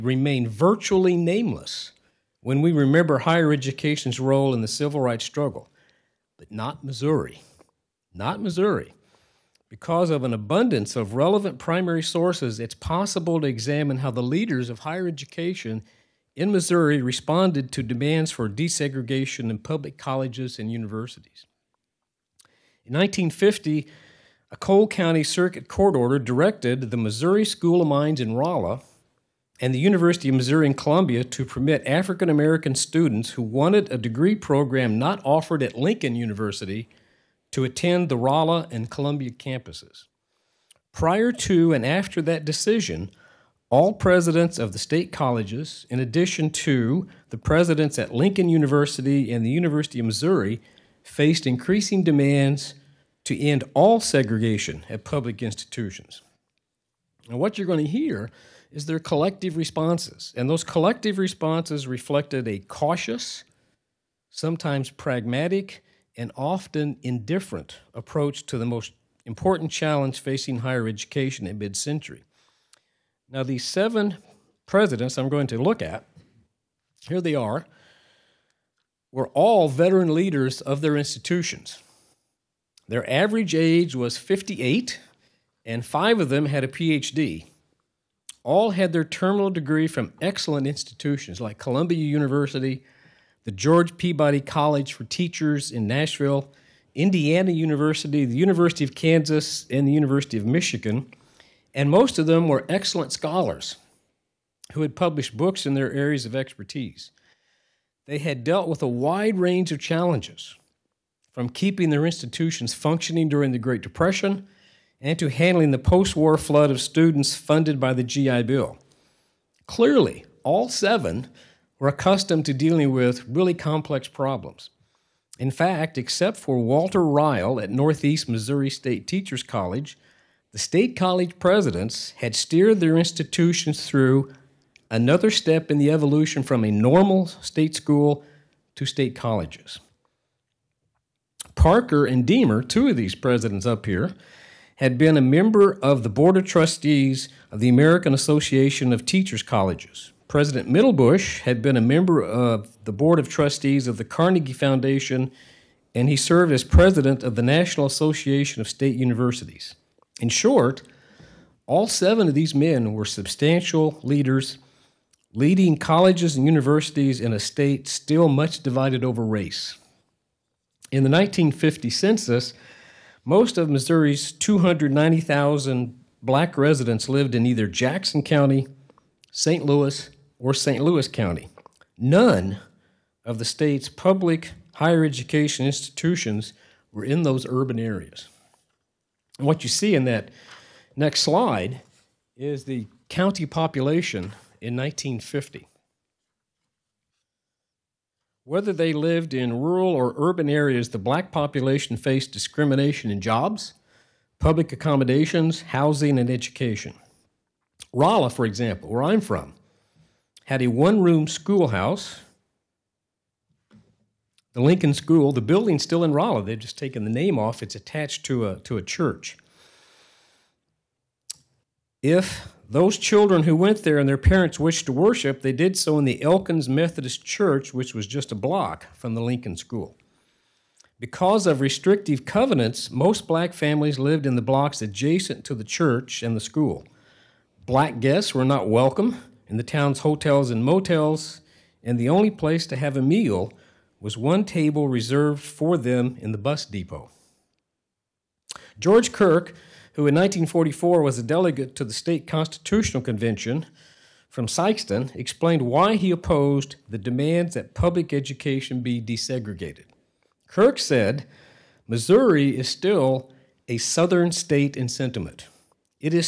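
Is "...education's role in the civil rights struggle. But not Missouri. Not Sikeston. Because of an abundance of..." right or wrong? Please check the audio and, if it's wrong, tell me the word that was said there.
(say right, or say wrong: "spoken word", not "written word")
wrong: "Missouri", not "Sikeston".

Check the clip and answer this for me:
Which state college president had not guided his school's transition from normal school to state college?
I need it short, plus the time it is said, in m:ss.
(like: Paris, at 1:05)
Walter Ryle, at 2:06.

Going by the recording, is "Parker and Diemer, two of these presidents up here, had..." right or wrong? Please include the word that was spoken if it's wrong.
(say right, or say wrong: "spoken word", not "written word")
right.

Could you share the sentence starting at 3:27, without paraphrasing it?
Rolla, for example, where I'm from, had a one room schoolhouse.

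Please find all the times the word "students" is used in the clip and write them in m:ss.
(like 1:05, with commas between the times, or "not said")
0:32, 1:56.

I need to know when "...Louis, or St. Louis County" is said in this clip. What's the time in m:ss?
2:59.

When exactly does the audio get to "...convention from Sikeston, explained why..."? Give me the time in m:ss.
4:13.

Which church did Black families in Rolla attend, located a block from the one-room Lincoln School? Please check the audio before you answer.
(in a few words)
Elkins Methodist Church.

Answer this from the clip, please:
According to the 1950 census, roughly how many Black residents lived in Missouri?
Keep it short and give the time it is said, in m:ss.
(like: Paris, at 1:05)
290,000, at 2:54.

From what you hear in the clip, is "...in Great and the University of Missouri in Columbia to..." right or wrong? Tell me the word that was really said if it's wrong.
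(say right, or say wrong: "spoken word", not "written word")
wrong: "Rolla", not "Great".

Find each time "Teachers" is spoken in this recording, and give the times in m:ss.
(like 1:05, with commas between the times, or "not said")
1:35, 2:09, 2:29.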